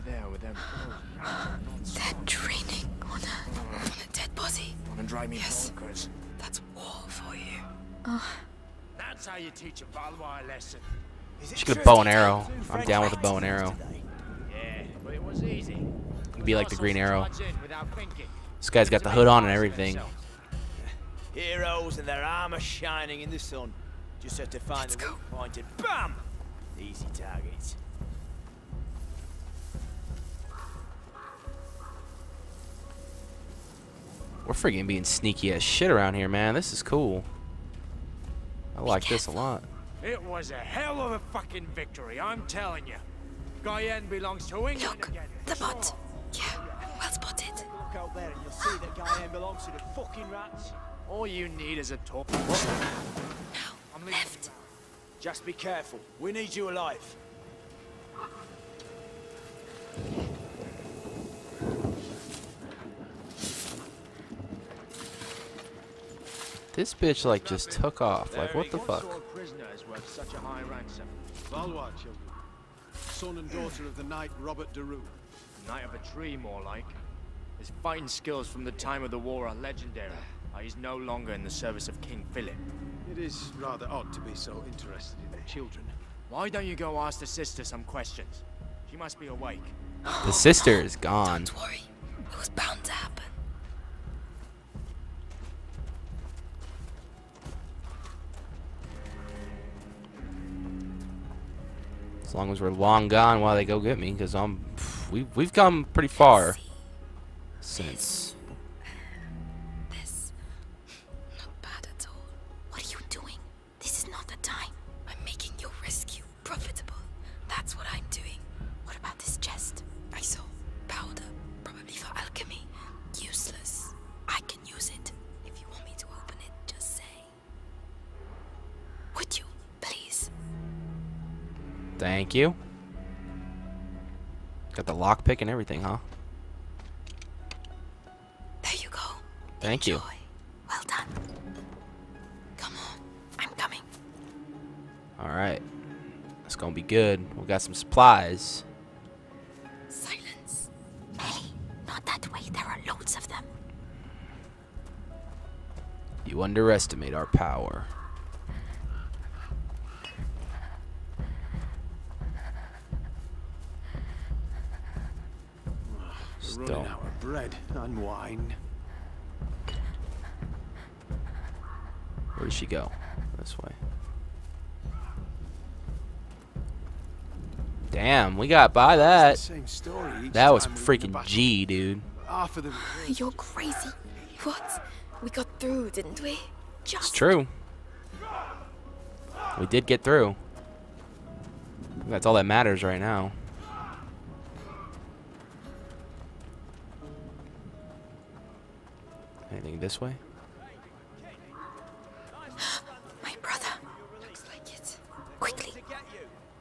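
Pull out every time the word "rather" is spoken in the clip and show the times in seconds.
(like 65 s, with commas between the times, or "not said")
83 s.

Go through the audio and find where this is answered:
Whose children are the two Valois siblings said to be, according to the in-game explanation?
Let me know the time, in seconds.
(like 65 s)
74 s.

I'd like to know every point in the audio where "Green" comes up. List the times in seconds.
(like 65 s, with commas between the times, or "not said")
16 s.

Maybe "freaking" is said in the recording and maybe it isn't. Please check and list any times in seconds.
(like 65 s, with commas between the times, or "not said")
34 s, 180 s.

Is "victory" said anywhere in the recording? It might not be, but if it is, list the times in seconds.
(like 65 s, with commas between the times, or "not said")
41 s.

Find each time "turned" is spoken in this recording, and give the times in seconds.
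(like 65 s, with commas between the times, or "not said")
not said.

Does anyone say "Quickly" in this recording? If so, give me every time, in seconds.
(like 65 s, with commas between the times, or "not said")
205 s.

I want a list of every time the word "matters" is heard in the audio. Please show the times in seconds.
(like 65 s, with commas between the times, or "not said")
192 s.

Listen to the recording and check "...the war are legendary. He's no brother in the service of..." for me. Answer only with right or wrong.
wrong.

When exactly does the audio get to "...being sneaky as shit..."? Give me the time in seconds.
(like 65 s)
34 s.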